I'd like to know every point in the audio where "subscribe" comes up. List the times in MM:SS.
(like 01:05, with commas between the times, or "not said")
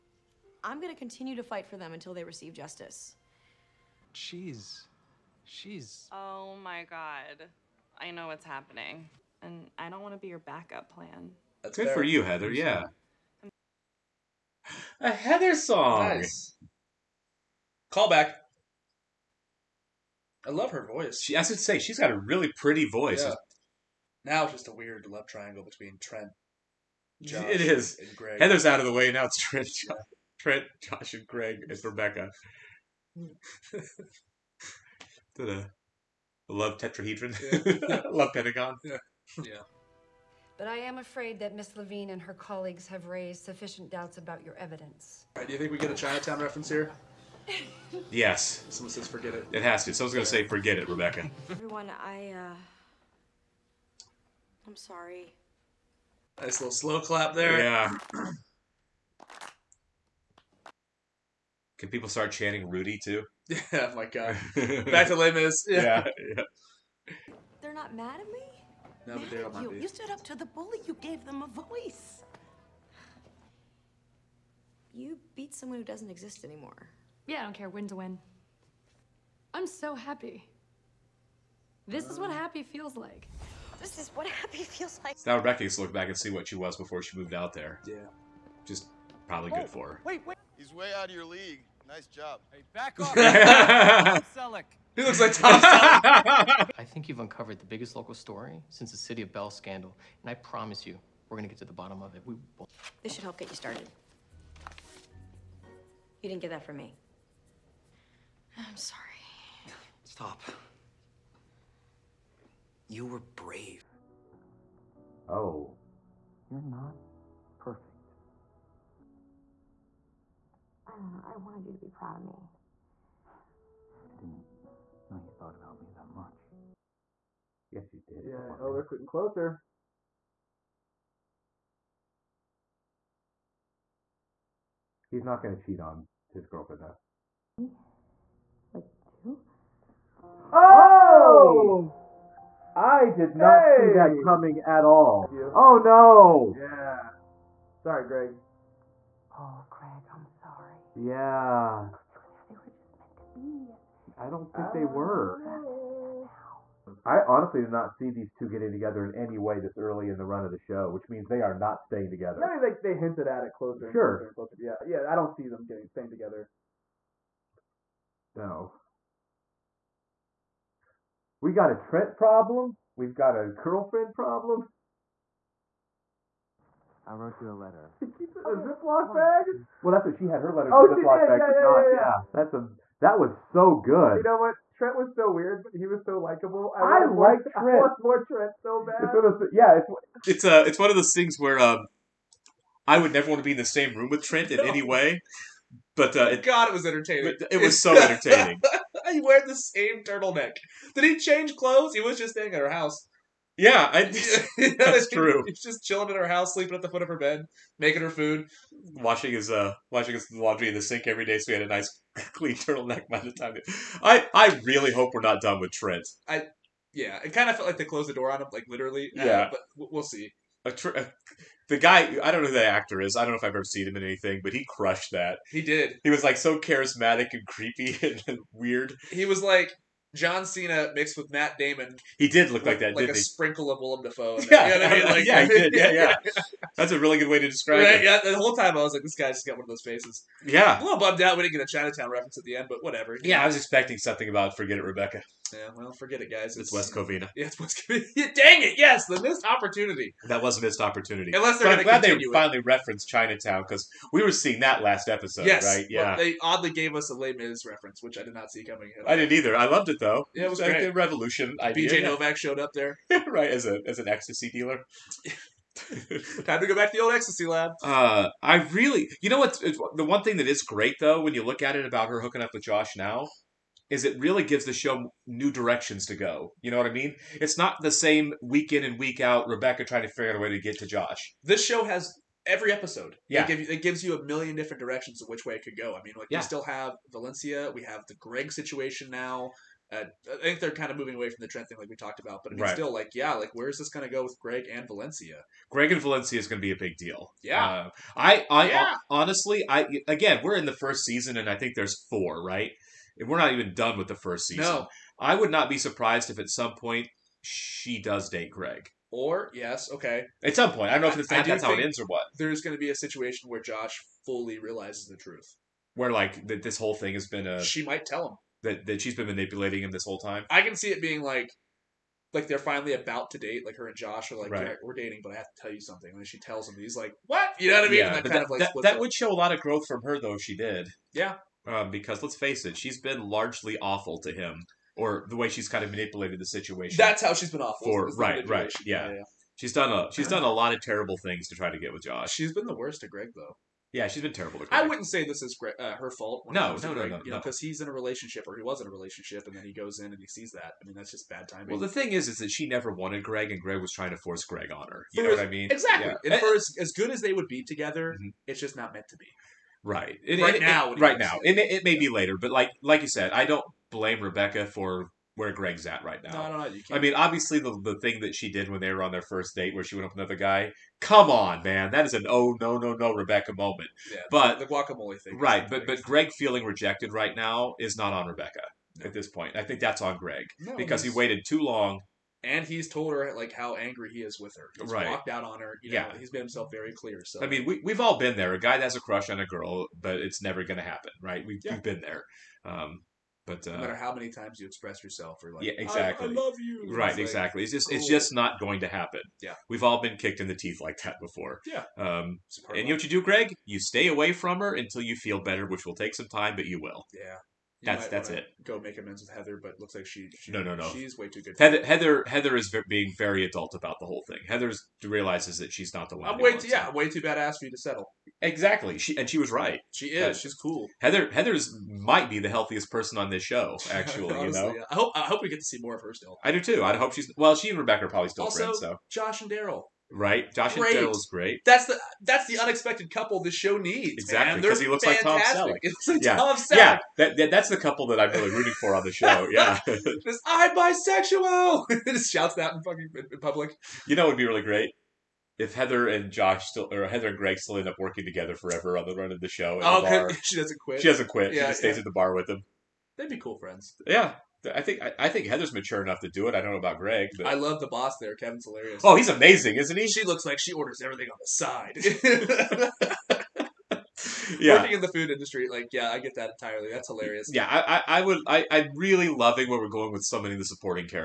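not said.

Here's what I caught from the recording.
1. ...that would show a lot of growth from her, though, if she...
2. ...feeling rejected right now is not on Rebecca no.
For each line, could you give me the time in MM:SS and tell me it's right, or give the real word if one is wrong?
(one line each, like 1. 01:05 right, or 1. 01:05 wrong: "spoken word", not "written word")
1. 05:28 right
2. 06:16 right.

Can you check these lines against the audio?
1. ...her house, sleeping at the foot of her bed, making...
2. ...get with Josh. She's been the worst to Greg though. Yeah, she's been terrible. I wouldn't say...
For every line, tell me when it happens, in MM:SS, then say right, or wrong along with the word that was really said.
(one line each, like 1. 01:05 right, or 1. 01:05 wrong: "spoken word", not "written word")
1. 03:26 right
2. 05:41 right.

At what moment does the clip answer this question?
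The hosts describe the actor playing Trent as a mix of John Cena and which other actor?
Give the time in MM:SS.
03:51.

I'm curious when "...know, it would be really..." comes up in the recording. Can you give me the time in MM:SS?
07:24.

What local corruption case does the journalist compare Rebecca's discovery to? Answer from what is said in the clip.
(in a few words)
City of Bell scandal.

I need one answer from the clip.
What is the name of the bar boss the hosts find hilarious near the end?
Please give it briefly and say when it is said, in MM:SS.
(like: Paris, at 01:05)
Kevin, at 07:38.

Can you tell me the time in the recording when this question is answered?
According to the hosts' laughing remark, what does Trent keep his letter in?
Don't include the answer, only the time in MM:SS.
02:58.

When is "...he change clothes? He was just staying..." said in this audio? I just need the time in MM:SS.
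03:21.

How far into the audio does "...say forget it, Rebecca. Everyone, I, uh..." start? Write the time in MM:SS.
00:50.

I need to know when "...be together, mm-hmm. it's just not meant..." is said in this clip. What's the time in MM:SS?
05:57.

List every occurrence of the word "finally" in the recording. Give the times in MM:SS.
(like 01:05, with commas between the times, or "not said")
04:12, 05:22.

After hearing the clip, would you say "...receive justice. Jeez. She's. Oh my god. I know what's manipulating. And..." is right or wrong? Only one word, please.
wrong.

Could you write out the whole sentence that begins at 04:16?
they oddly gave us a Les Mis reference, which I did not see coming.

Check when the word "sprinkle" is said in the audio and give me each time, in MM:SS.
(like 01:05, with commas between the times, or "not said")
03:53.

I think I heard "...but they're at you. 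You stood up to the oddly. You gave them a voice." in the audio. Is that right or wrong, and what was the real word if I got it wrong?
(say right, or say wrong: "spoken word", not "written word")
wrong: "bully", not "oddly".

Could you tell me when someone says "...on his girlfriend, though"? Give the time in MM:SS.
02:15.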